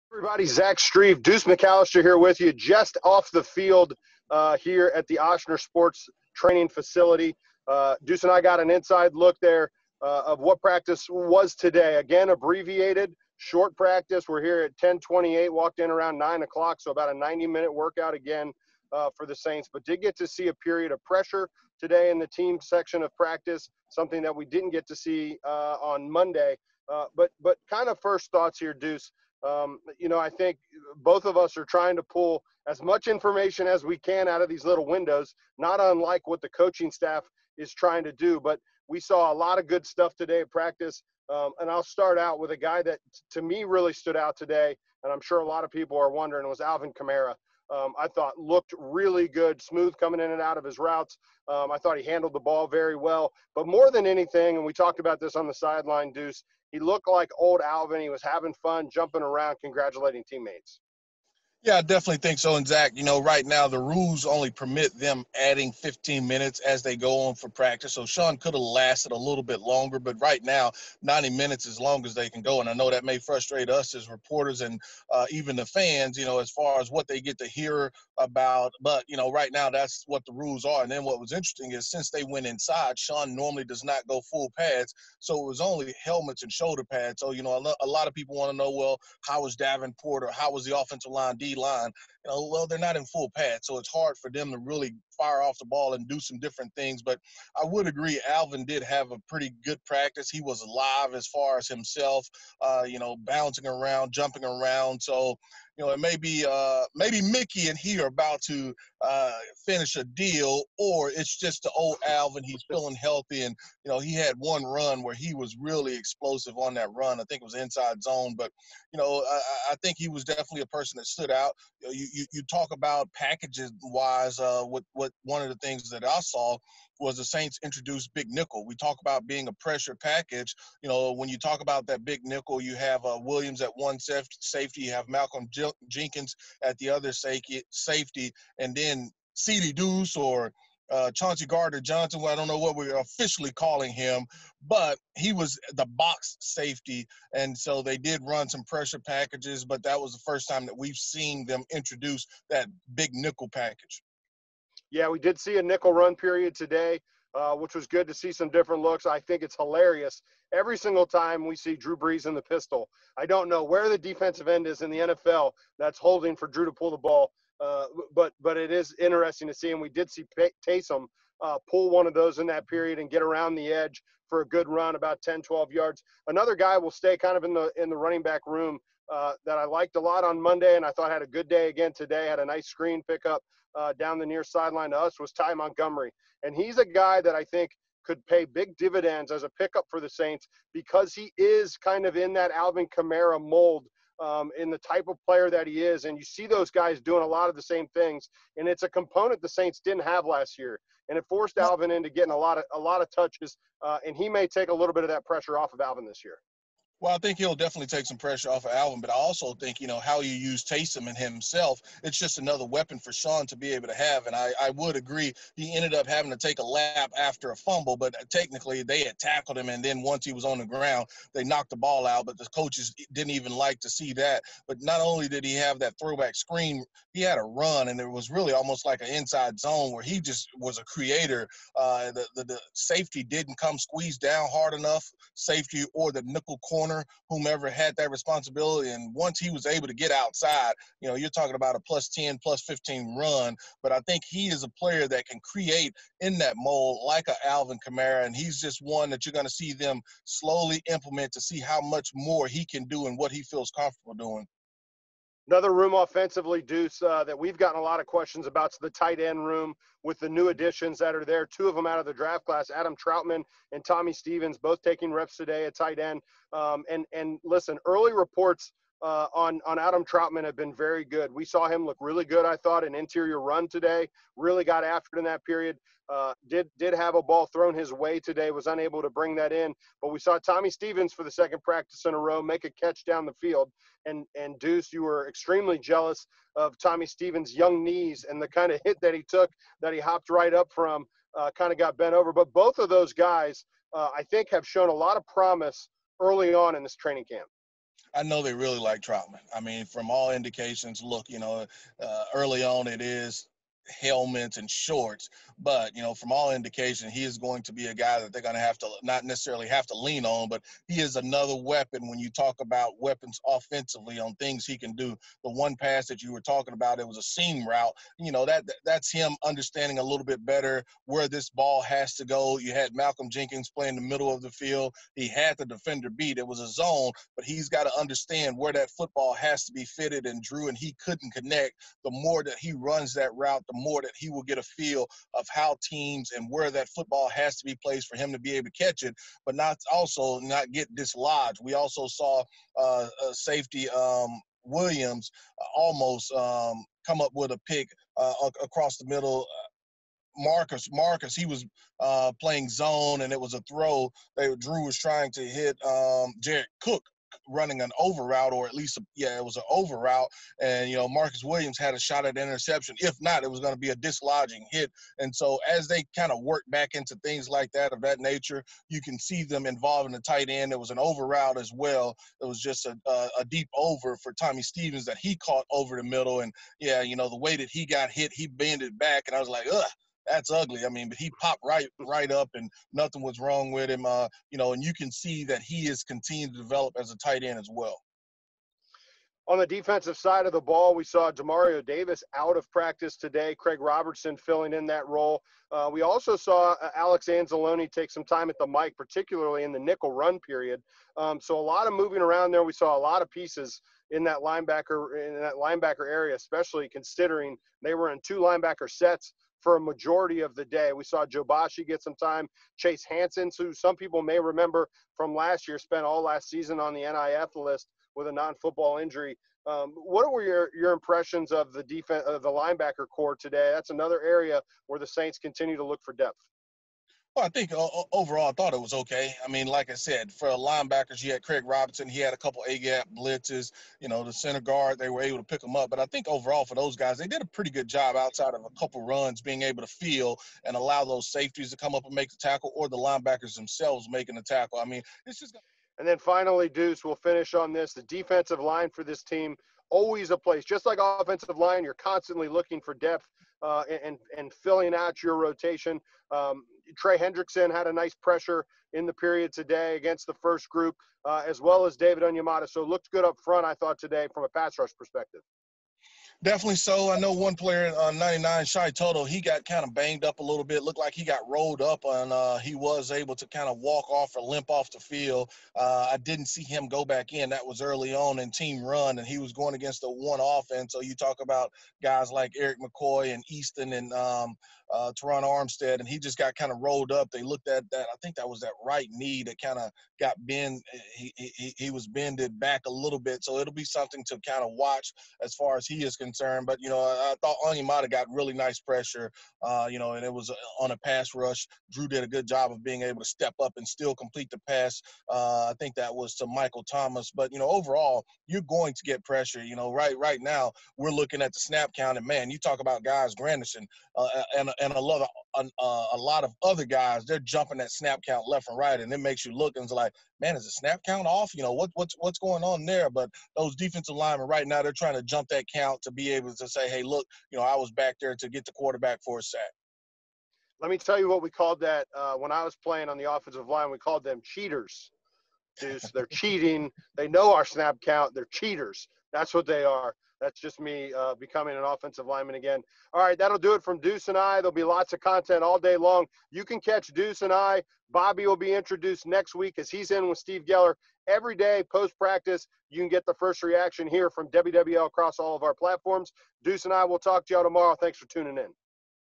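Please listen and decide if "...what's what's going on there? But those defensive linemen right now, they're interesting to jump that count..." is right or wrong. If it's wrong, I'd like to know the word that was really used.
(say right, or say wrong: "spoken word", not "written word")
wrong: "trying", not "interesting".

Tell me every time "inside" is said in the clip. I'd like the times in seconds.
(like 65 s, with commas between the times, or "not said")
8 s, 82 s, 117 s, 229 s.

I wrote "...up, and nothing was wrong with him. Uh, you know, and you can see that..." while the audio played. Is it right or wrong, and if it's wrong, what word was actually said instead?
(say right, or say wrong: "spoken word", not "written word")
right.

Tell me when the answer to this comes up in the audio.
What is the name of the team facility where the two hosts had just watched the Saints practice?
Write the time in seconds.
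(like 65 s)
5 s.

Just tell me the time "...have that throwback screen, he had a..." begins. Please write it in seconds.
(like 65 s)
225 s.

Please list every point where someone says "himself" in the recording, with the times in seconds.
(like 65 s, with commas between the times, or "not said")
101 s, 211 s.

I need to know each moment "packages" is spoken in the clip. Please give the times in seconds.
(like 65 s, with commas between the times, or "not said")
123 s, 129 s, 148 s, 153 s.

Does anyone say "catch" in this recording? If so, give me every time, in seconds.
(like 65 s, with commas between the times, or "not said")
282 s, 338 s, 546 s.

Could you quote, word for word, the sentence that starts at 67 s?
So Sean could have lasted a little bit longer, but right now 90 minutes as long as they can go.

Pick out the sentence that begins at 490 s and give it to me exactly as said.
Eh, he, he, he was bended back a little bit.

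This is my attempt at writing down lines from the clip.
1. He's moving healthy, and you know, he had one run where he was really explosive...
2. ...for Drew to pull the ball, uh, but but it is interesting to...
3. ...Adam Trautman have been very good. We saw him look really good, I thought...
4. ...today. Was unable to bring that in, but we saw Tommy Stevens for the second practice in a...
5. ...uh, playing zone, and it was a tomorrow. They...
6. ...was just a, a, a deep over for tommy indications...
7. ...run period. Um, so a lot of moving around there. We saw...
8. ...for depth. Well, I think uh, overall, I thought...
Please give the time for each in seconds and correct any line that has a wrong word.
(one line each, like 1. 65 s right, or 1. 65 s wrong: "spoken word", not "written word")
1. 112 s wrong: "feeling", not "moving"
2. 166 s right
3. 269 s right
4. 278 s right
5. 351 s wrong: "throw", not "tomorrow"
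6. 372 s wrong: "stevens", not "indications"
7. 400 s right
8. 426 s right.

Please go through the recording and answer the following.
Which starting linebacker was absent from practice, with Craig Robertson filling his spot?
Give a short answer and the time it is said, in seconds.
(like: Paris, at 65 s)
Demario Davis, at 391 s.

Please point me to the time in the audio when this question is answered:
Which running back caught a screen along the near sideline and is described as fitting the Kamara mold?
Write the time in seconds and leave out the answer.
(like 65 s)
185 s.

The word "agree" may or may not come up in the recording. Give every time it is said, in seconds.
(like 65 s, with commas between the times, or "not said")
97 s, 214 s.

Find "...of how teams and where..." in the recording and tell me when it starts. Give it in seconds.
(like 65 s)
335 s.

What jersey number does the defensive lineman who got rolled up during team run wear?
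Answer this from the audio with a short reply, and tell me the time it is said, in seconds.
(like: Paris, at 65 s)
99, at 468 s.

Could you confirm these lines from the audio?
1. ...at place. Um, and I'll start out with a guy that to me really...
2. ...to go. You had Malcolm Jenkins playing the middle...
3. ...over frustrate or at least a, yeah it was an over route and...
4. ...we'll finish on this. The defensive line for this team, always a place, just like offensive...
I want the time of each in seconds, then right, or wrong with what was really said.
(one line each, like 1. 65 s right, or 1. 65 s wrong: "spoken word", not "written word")
1. 40 s wrong: "practice", not "place"
2. 322 s right
3. 357 s wrong: "route", not "frustrate"
4. 447 s right.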